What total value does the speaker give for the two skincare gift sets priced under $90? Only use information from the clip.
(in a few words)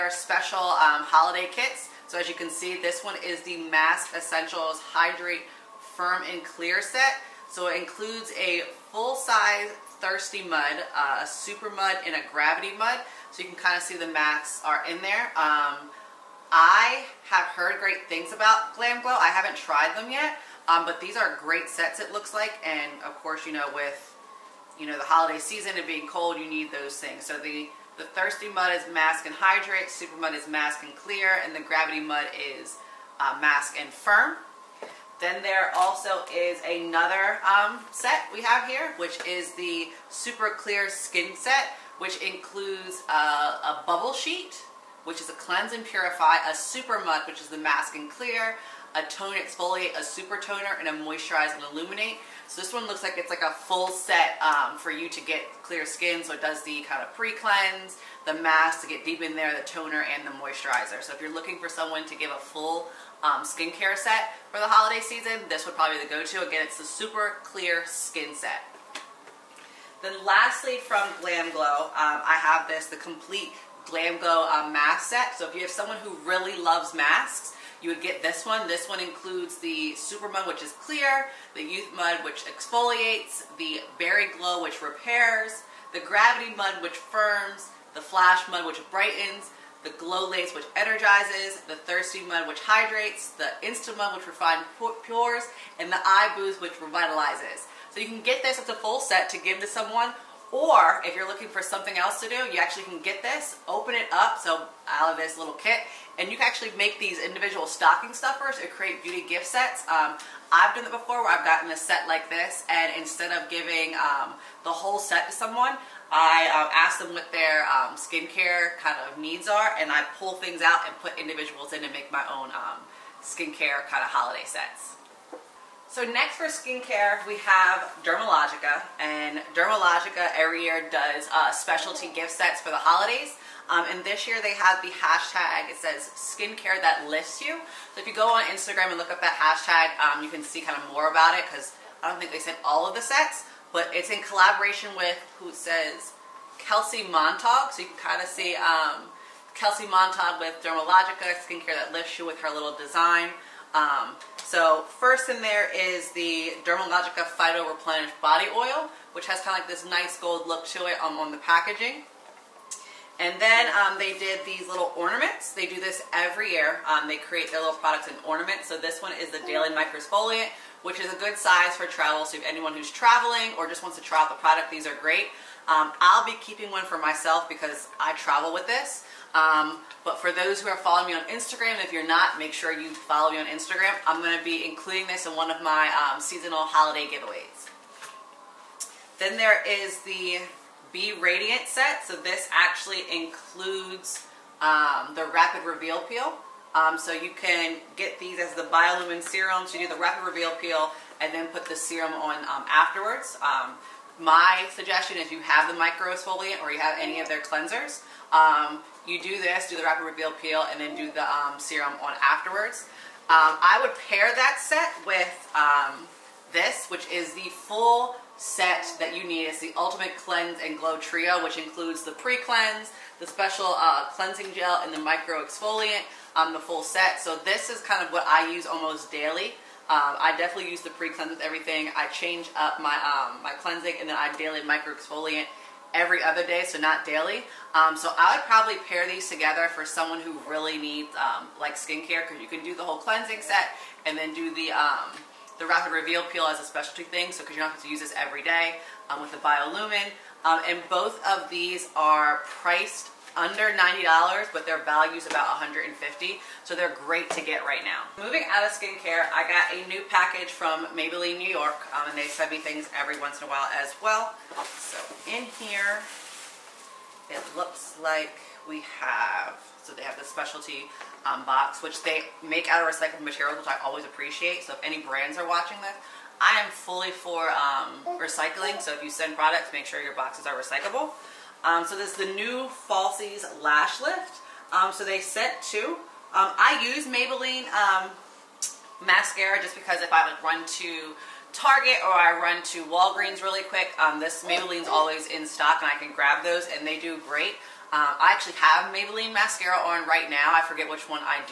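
$150.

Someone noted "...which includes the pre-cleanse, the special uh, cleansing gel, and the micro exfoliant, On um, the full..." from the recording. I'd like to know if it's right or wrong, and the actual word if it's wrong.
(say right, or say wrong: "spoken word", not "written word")
right.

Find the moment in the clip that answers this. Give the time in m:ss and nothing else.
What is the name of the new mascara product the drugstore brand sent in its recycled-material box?
4:42.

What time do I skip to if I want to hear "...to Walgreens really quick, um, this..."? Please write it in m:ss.
4:52.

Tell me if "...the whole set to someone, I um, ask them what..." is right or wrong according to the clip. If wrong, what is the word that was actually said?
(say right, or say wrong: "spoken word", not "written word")
right.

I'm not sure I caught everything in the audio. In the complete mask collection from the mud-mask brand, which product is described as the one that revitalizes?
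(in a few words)
Eye Boost.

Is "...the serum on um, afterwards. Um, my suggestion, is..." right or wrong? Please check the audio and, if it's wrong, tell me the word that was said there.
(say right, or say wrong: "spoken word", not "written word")
right.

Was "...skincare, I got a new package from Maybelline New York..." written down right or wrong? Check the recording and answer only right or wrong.
right.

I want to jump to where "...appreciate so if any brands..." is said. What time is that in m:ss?
4:34.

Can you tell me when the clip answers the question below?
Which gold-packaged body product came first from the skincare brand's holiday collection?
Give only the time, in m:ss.
2:37.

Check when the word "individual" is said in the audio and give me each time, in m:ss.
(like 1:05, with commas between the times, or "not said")
1:47, 2:01.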